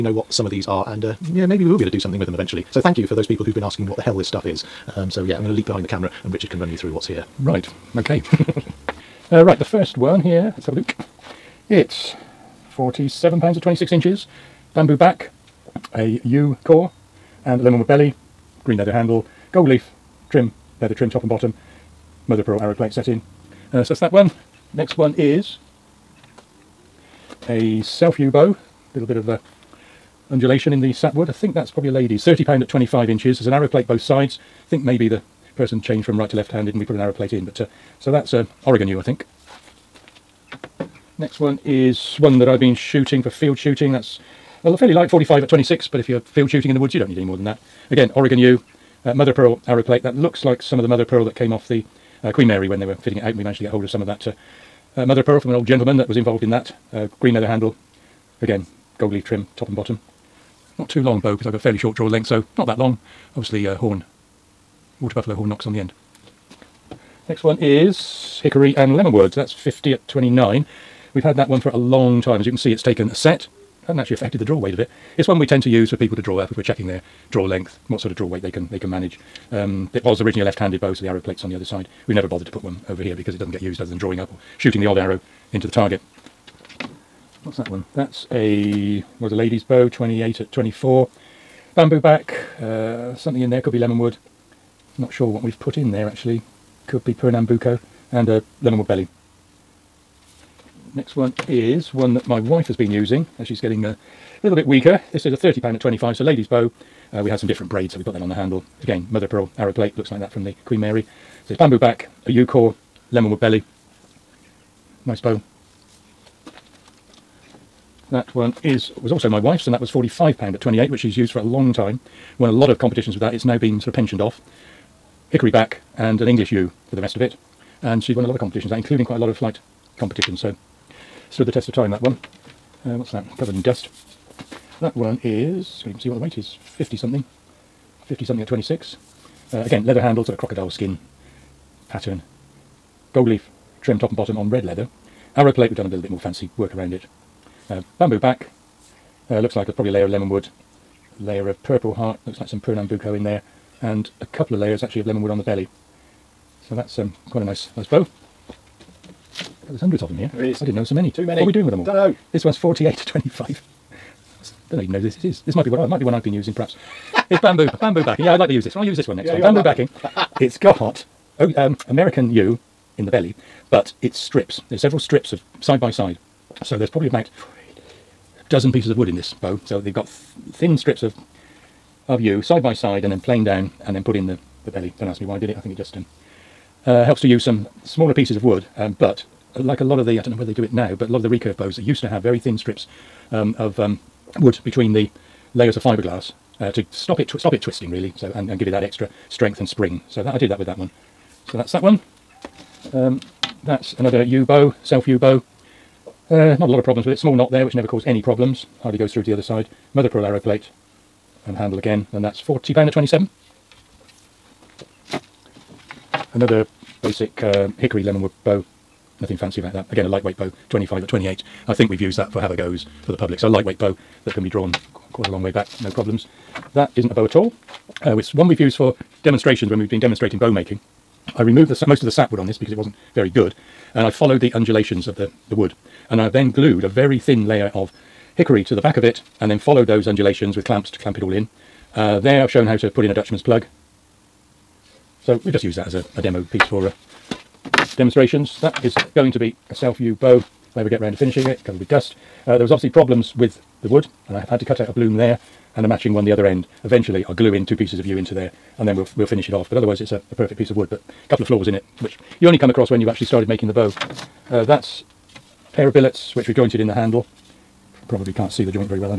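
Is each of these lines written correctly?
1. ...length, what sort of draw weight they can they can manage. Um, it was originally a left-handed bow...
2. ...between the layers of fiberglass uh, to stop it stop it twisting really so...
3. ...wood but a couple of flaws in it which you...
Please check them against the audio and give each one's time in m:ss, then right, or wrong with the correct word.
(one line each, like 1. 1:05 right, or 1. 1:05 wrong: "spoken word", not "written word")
1. 1:17 right
2. 3:14 right
3. 4:20 right.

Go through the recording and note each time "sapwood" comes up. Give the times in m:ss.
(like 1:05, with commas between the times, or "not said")
0:30, 3:52.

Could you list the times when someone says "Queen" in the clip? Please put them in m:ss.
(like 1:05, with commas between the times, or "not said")
0:52, 1:50.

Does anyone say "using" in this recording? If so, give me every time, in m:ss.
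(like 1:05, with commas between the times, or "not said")
1:42, 2:46.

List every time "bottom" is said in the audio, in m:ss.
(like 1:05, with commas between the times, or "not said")
0:21, 0:59, 2:24.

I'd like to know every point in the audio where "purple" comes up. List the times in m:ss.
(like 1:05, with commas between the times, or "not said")
2:31.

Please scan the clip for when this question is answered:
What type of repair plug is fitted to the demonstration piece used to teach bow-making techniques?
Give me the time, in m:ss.
4:03.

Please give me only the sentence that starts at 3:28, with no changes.
Hardly goes through to the other side.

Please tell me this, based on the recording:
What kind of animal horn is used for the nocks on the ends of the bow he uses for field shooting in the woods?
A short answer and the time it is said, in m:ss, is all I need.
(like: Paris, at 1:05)
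Water buffalo, at 1:05.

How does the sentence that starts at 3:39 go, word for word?
Again, a lightweight bow, 25 at 28.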